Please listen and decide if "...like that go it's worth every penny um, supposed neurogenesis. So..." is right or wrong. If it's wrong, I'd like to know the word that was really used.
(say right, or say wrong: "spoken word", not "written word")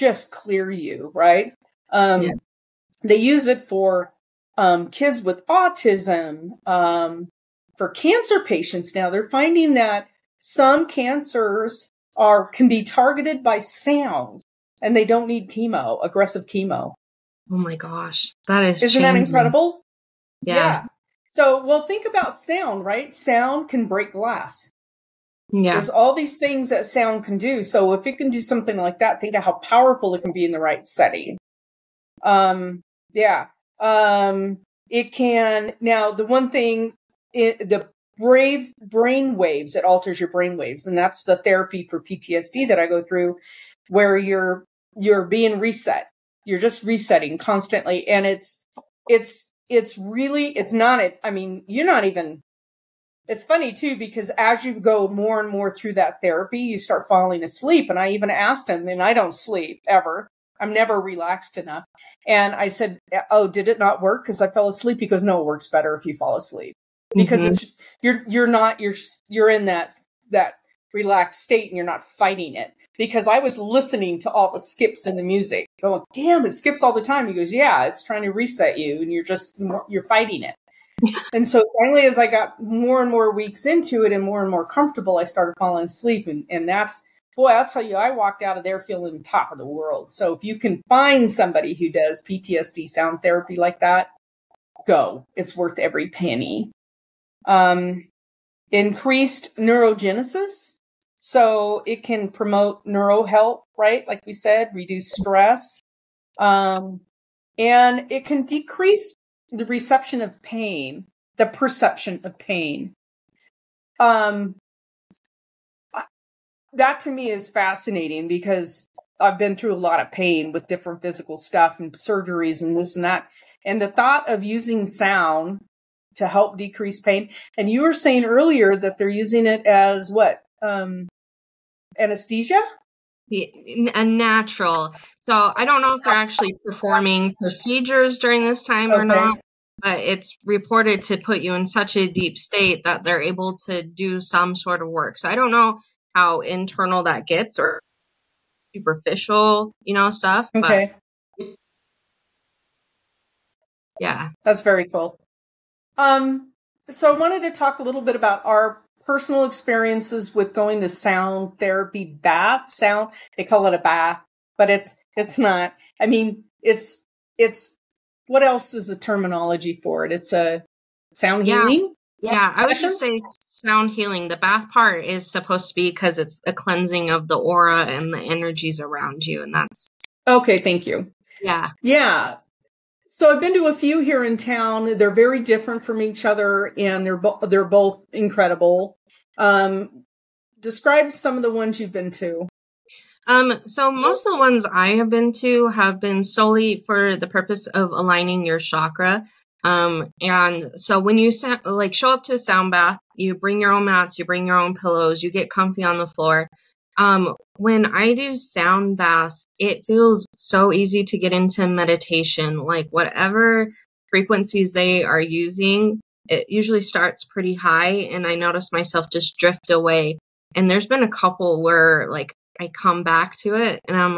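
wrong: "increased", not "supposed".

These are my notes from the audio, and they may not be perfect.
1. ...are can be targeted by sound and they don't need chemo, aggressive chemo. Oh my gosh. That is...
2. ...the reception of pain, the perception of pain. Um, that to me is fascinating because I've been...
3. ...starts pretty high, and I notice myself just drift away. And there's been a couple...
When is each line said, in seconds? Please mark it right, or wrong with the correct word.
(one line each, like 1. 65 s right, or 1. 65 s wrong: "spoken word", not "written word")
1. 12 s right
2. 109 s right
3. 216 s right.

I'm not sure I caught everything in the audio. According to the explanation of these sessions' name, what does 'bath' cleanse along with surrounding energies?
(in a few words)
the aura.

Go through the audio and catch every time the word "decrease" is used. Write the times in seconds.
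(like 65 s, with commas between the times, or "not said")
108 s, 126 s.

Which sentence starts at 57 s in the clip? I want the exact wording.
And I even asked him, and I don't sleep ever.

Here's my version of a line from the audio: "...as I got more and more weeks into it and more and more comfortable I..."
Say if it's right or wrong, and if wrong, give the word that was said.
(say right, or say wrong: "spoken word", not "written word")
right.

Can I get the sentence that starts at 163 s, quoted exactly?
They call it a bath, but it's, it's not.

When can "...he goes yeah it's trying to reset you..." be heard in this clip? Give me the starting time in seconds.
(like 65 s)
77 s.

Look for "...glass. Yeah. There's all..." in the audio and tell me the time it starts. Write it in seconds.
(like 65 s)
24 s.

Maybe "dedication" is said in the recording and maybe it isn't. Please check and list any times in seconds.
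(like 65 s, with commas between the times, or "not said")
not said.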